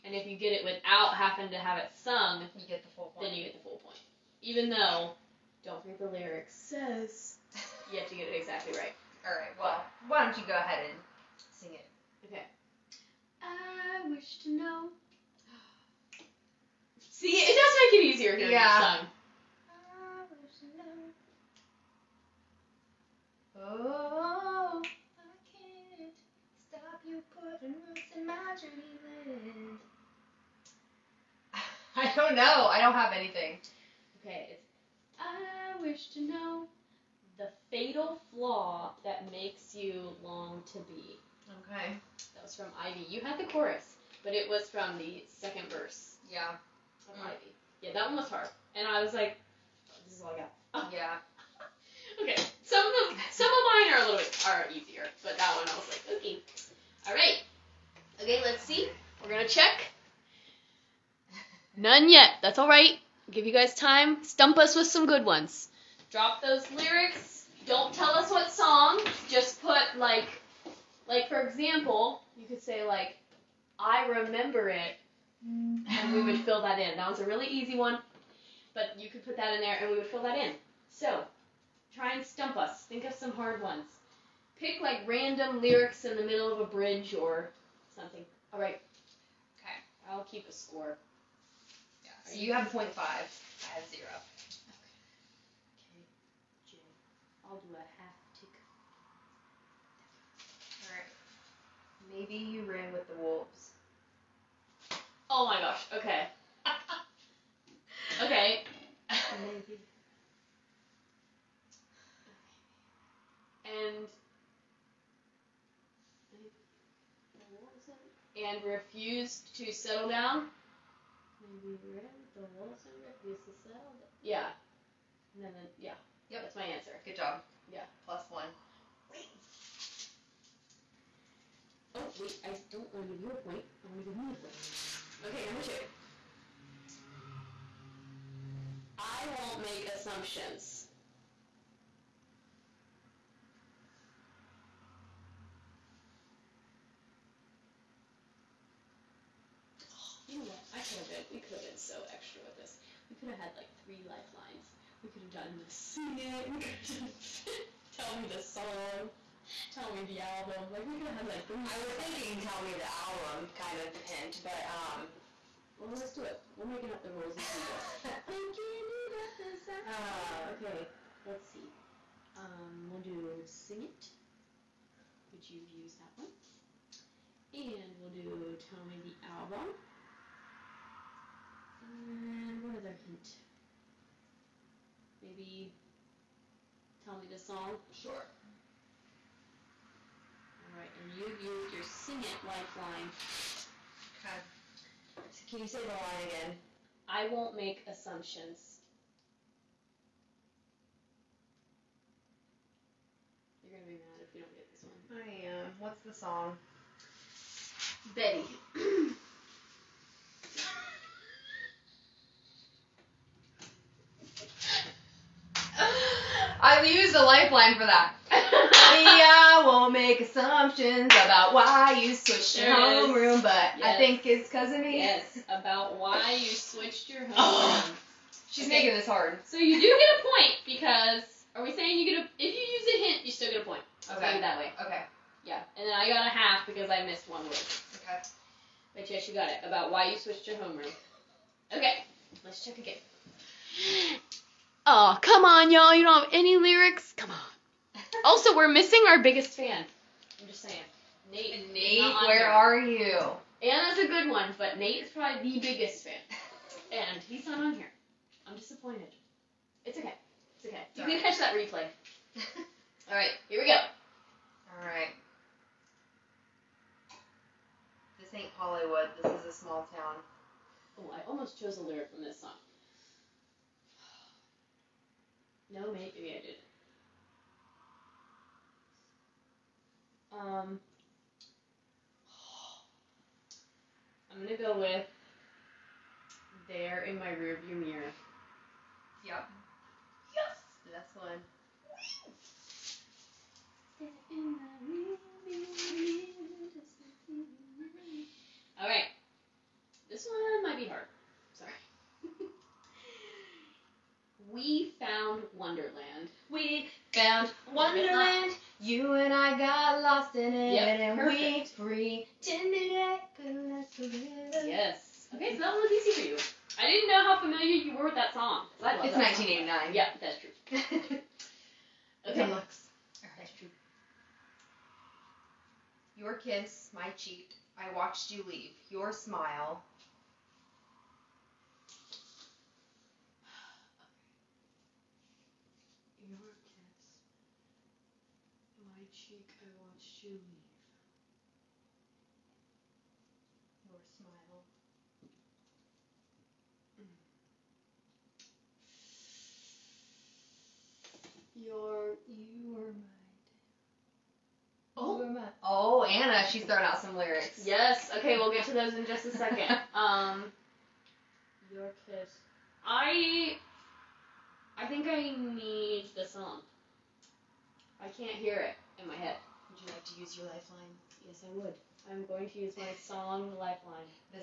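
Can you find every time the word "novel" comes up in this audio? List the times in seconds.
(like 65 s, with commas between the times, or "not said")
not said.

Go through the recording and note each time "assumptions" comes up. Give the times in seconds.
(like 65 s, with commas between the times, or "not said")
139 s, 197 s, 220 s.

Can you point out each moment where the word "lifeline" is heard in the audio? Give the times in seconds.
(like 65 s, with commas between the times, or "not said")
154 s, 192 s, 217 s, 373 s.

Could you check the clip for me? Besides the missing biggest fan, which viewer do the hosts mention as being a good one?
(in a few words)
Anna.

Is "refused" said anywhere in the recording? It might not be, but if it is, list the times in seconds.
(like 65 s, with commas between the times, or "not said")
118 s, 123 s.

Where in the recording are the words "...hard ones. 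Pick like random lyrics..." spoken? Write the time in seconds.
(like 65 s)
83 s.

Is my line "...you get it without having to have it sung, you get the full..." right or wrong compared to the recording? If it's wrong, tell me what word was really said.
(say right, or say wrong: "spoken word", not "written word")
right.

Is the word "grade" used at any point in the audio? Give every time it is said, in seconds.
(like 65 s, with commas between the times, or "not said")
not said.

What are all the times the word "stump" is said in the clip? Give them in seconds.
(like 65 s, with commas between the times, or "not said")
64 s, 82 s.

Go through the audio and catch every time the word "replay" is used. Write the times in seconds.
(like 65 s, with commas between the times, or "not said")
261 s.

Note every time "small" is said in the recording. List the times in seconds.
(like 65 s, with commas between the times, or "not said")
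269 s.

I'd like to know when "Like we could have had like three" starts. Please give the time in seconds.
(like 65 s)
160 s.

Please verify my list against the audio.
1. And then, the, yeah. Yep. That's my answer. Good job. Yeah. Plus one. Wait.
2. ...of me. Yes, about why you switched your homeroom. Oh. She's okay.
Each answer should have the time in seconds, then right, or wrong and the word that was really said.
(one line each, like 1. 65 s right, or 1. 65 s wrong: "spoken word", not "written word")
1. 125 s right
2. 224 s right.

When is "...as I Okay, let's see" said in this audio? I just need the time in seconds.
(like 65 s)
169 s.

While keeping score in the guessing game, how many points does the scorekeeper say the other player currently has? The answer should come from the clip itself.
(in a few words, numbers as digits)
0.5.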